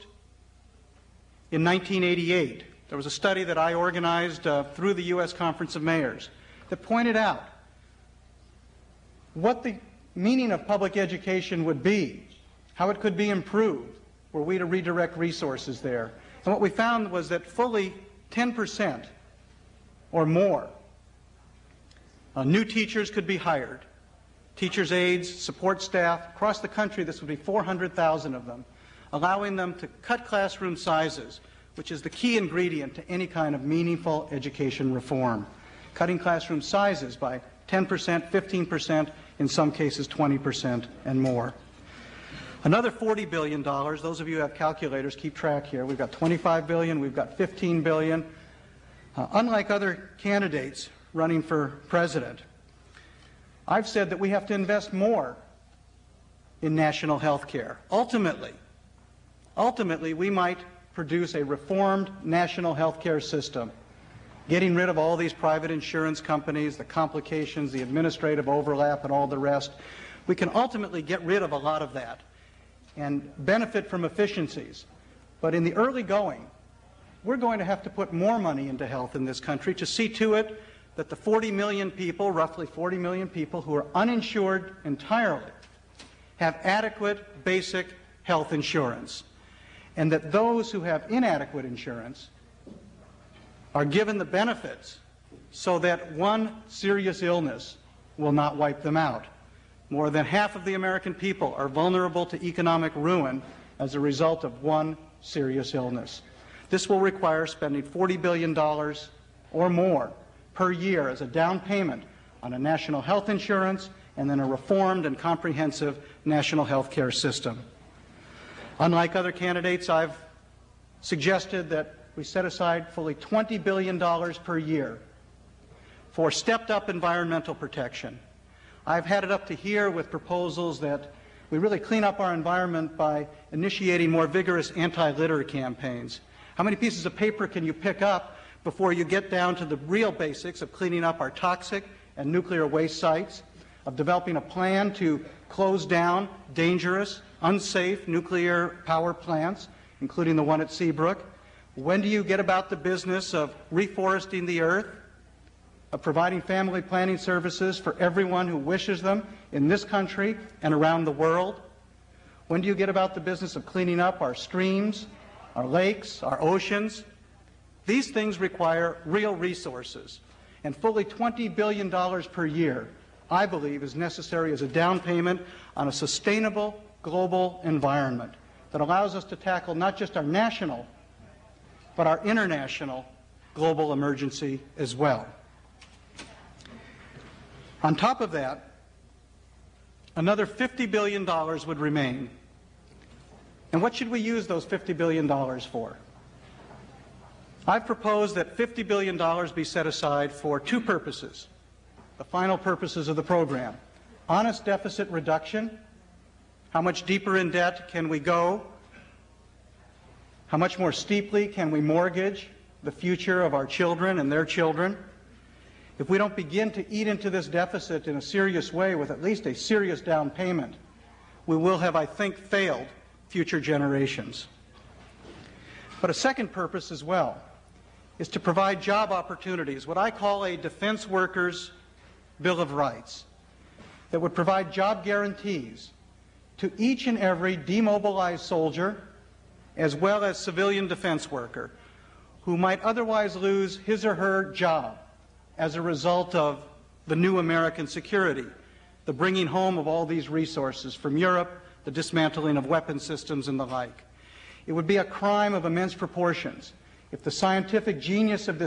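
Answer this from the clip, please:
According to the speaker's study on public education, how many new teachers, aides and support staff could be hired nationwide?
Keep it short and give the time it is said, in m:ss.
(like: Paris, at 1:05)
400,000, at 0:27.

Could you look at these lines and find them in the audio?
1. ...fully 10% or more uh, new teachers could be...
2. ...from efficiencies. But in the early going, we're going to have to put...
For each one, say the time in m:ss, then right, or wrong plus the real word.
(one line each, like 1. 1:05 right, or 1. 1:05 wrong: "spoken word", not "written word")
1. 0:17 right
2. 1:13 right.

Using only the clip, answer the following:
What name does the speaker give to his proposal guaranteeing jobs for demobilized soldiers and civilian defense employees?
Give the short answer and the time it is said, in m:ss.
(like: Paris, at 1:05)
defense workers' bill of rights, at 3:50.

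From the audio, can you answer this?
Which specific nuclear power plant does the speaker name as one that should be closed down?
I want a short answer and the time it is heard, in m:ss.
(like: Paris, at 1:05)
Seabrook, at 2:30.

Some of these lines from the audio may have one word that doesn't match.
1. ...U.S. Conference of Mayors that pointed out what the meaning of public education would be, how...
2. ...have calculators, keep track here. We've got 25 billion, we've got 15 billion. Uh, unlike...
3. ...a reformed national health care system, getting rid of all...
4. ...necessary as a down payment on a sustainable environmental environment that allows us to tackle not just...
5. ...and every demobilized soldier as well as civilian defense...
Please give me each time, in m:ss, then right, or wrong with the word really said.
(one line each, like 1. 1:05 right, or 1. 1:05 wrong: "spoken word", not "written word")
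1. 0:05 right
2. 0:44 right
3. 1:01 right
4. 2:53 wrong: "global", not "environmental"
5. 3:57 right.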